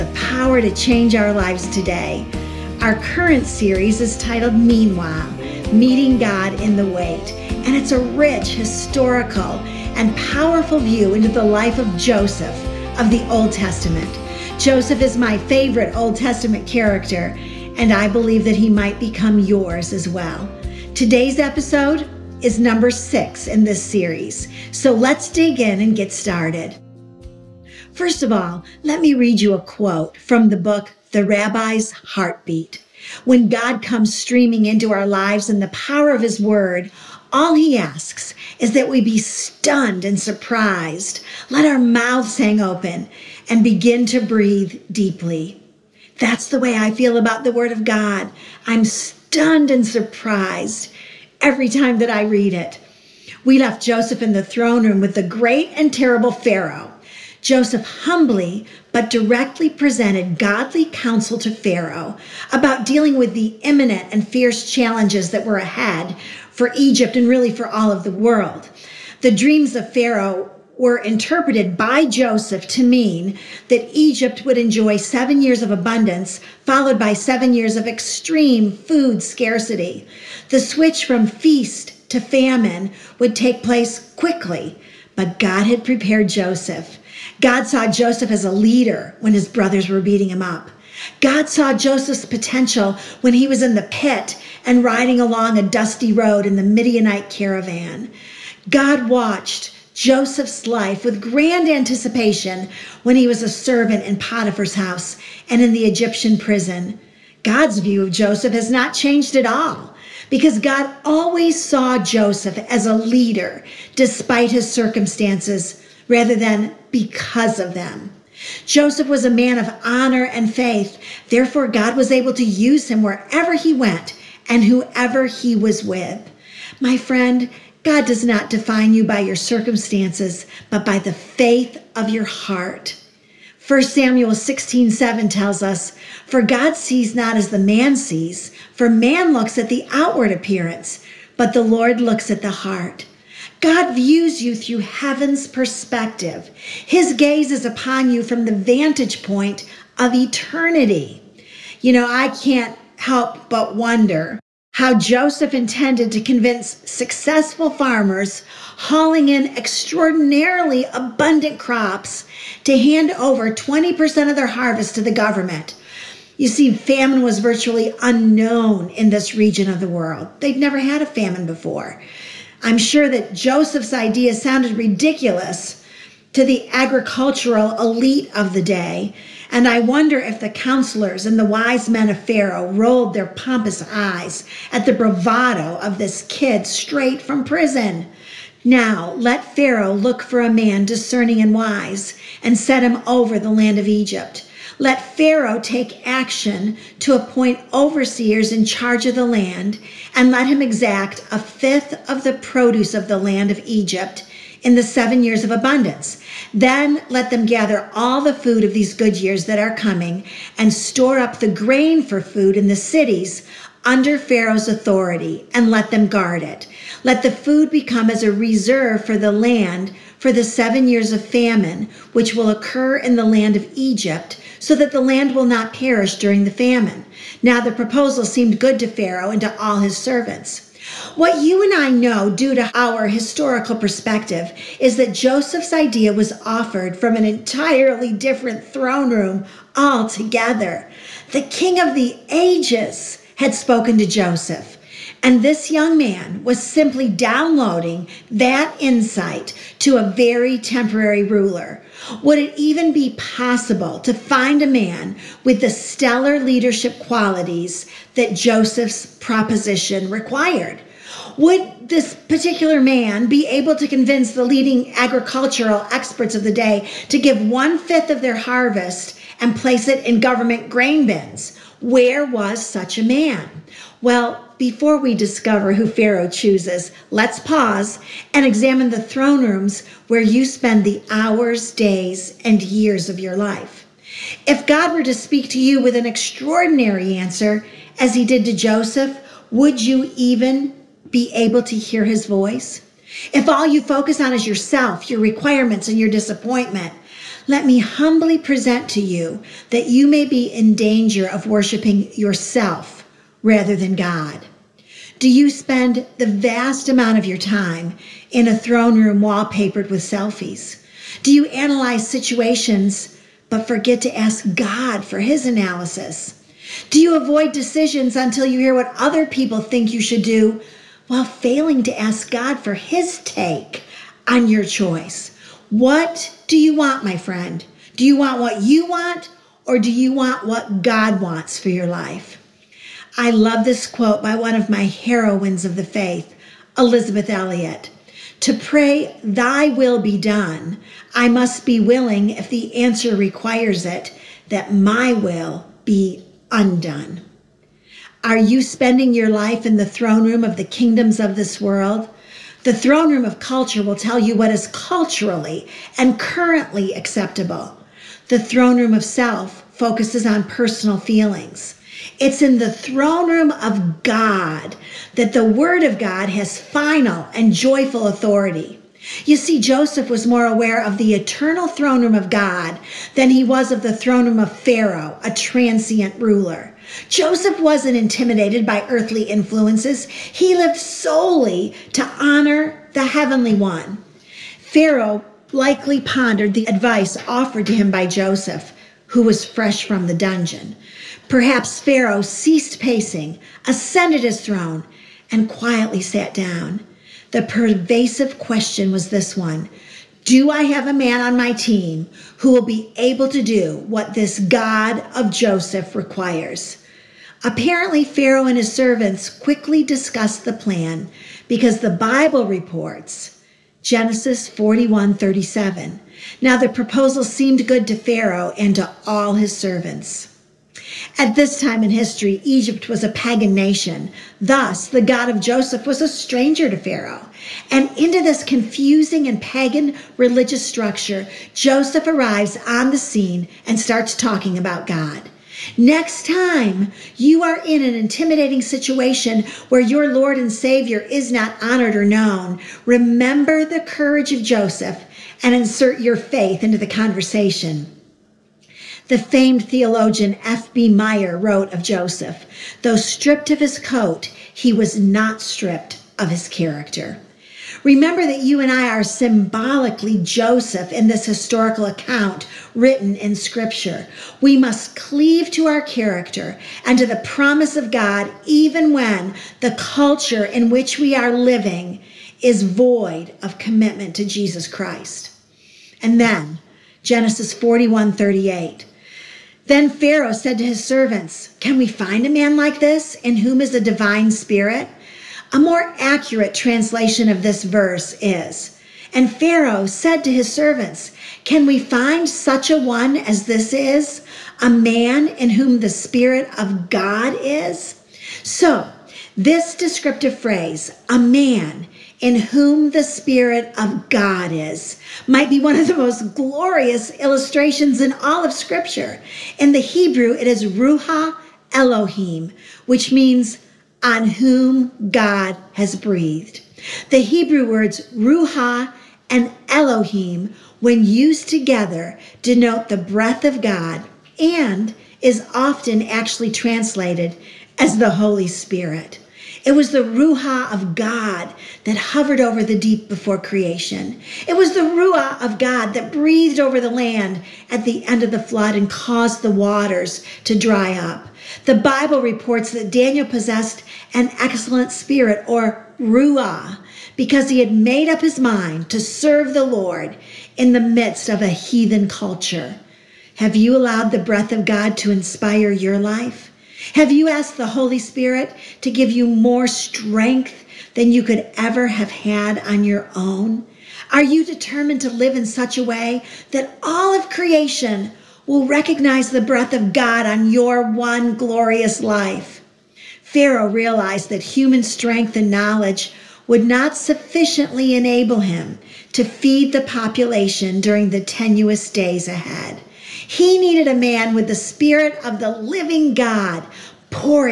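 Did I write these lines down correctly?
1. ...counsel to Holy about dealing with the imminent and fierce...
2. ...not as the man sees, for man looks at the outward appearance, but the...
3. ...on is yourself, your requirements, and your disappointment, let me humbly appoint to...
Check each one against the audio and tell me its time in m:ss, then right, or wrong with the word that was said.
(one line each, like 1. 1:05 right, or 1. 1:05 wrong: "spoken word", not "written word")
1. 1:00 wrong: "Pharaoh", not "Holy"
2. 2:17 right
3. 4:54 wrong: "present", not "appoint".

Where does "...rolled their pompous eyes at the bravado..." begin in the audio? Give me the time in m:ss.
3:02.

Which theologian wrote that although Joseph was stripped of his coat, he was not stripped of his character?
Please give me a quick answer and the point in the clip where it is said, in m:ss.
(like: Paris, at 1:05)
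F.B. Meyer, at 7:30.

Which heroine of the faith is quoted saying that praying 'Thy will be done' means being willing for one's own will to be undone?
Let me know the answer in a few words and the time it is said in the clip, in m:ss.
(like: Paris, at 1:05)
Elisabeth Elliot, at 5:36.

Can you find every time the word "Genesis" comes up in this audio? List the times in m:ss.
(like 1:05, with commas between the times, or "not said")
6:53, 7:57.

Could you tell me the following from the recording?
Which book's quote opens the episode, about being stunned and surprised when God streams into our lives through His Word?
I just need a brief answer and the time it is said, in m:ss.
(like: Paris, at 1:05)
The Rabbi's Heartbeat, at 0:31.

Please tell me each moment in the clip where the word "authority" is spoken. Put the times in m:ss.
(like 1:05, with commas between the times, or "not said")
3:34, 6:08.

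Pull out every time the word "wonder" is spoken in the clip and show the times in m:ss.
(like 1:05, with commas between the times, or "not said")
2:33, 2:59.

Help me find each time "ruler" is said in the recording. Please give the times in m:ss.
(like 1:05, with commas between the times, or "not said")
4:11, 6:16.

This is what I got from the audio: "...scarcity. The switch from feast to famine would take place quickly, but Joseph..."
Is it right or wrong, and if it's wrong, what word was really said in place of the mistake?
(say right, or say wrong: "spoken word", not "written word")
wrong: "God", not "Joseph".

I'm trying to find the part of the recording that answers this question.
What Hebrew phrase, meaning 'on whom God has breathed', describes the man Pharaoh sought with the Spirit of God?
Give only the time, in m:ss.
8:30.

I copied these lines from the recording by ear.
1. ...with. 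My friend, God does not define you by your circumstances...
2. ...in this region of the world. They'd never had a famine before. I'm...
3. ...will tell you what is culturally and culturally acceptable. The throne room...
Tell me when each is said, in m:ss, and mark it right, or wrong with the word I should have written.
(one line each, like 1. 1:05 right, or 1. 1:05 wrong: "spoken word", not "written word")
1. 2:05 right
2. 2:48 right
3. 5:53 wrong: "currently", not "culturally".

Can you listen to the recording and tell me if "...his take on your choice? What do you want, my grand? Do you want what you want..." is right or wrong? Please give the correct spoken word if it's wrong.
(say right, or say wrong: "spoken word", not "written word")
wrong: "friend", not "grand".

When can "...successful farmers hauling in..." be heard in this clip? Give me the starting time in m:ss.
2:36.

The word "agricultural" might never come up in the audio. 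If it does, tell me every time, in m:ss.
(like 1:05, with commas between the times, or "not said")
2:56, 4:24.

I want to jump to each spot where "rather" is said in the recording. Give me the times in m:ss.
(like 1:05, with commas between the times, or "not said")
1:56, 5:03.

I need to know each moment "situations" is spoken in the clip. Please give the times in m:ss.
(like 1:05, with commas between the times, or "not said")
5:12, 7:18.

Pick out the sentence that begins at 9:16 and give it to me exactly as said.
Have you asked the Holy Spirit to give you more strength than you could ever have had on your own?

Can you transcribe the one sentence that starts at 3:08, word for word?
Now let Pharaoh look for a man discerning and wise and set him over the land of Egypt.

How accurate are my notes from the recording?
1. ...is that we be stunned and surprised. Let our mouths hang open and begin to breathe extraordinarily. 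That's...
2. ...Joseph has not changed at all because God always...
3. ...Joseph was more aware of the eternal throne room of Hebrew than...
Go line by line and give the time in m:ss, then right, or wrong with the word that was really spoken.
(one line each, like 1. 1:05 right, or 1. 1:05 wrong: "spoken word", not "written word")
1. 0:38 wrong: "deeply", not "extraordinarily"
2. 1:48 right
3. 6:09 wrong: "God", not "Hebrew".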